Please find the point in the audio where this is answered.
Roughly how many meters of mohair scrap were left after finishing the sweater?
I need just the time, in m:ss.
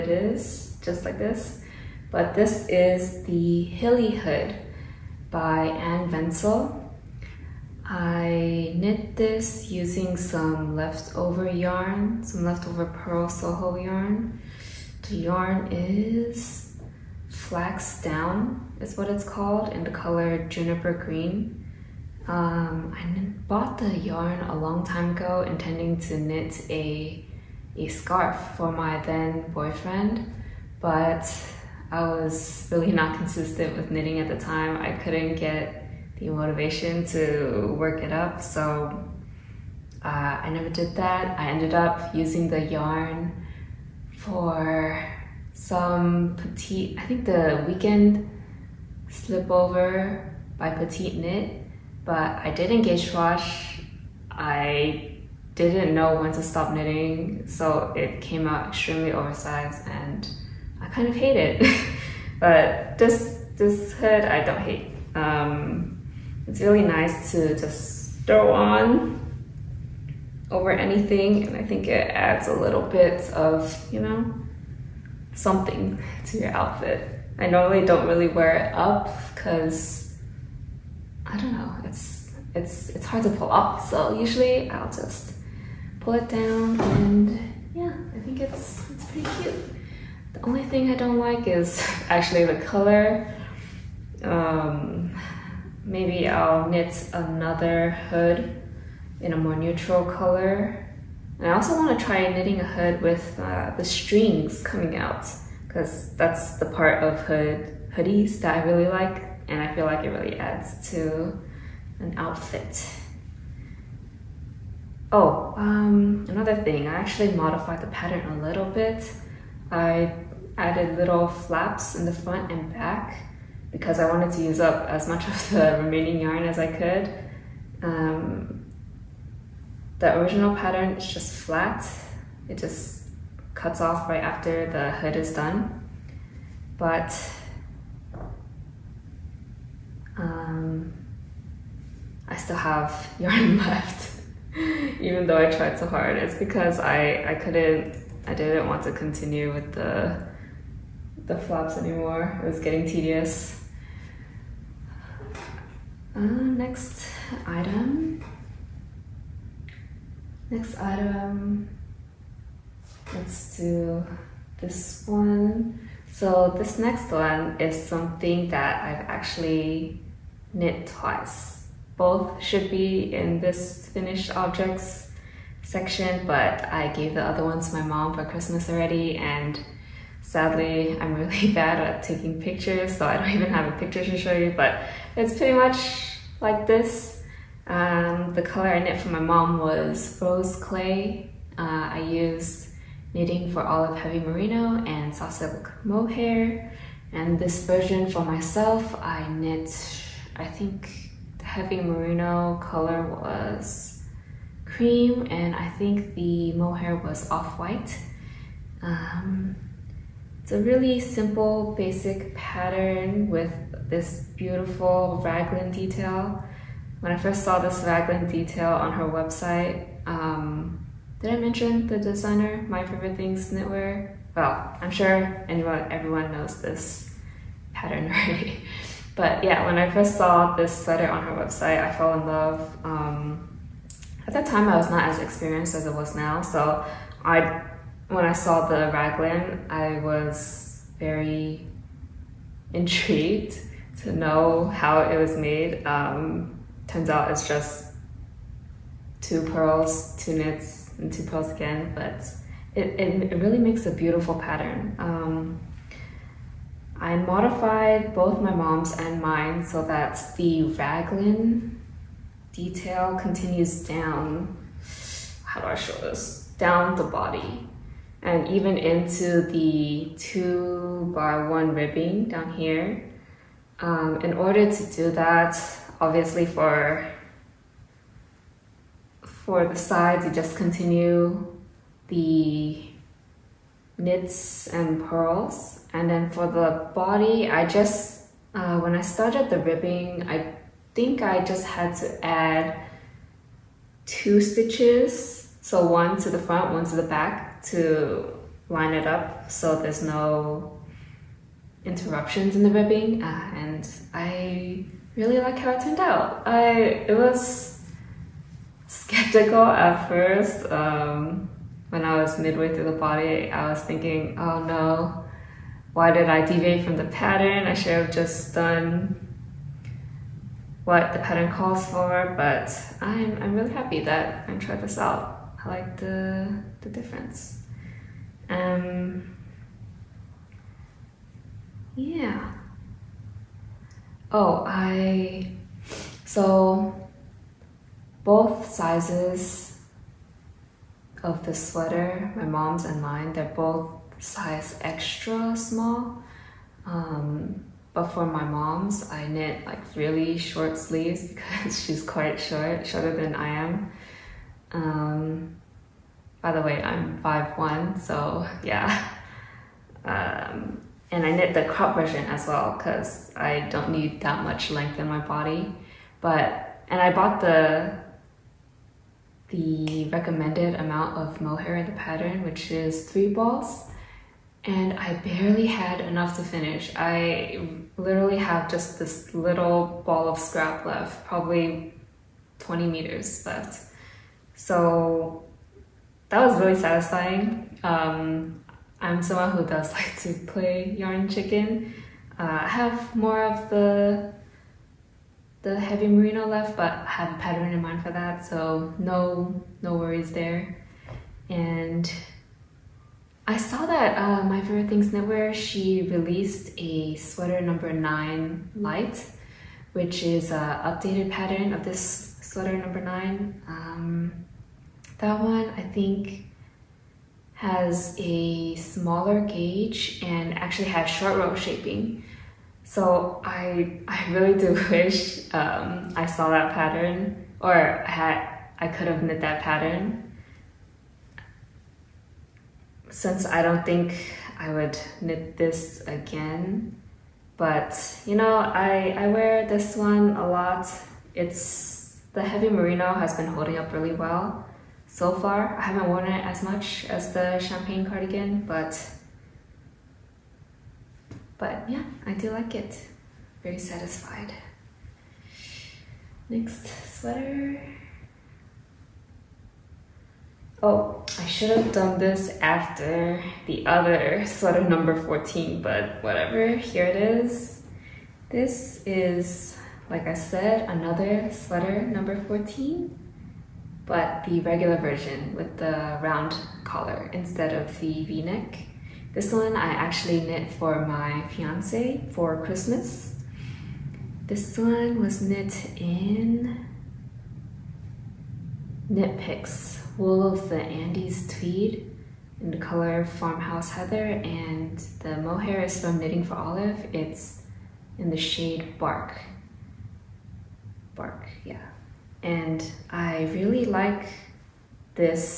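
6:22.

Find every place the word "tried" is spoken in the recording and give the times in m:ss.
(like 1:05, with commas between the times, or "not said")
2:25, 5:24.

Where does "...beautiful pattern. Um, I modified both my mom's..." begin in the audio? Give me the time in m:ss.
4:13.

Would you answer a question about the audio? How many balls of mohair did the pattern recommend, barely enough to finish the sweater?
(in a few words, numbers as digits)
3.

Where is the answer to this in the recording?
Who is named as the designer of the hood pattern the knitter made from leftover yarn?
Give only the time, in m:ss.
0:05.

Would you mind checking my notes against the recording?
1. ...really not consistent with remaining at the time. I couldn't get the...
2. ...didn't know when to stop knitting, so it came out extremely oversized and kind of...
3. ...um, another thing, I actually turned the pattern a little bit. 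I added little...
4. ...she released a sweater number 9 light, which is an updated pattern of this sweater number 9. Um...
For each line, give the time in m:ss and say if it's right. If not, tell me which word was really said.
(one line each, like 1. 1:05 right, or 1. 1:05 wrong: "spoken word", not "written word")
1. 0:32 wrong: "knitting", not "remaining"
2. 0:55 right
3. 1:55 wrong: "modified", not "turned"
4. 6:45 right.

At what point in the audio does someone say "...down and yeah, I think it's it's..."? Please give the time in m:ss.
1:26.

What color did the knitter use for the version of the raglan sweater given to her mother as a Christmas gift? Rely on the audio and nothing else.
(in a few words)
Rose clay.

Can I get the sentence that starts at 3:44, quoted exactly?
Well, I'm sure anyone, everyone knows this pattern already.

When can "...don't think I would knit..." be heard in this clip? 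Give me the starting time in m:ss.
7:13.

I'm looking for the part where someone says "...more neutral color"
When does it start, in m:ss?
1:39.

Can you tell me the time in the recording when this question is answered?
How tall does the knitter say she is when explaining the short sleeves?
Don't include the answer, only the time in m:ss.
5:57.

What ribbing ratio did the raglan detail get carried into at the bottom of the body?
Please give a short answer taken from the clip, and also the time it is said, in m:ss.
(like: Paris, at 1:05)
2 by 1, at 4:30.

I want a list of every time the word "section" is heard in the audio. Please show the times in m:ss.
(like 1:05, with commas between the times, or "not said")
2:55.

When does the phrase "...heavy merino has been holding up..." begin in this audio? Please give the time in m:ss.
7:22.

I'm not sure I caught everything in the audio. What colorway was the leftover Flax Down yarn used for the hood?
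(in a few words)
Juniper Green.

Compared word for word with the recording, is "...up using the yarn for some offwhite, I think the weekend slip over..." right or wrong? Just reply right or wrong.
wrong.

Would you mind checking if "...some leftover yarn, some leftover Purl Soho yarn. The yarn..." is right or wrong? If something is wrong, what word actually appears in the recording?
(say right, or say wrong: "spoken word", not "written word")
right.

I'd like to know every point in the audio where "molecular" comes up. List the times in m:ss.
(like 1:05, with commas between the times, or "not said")
not said.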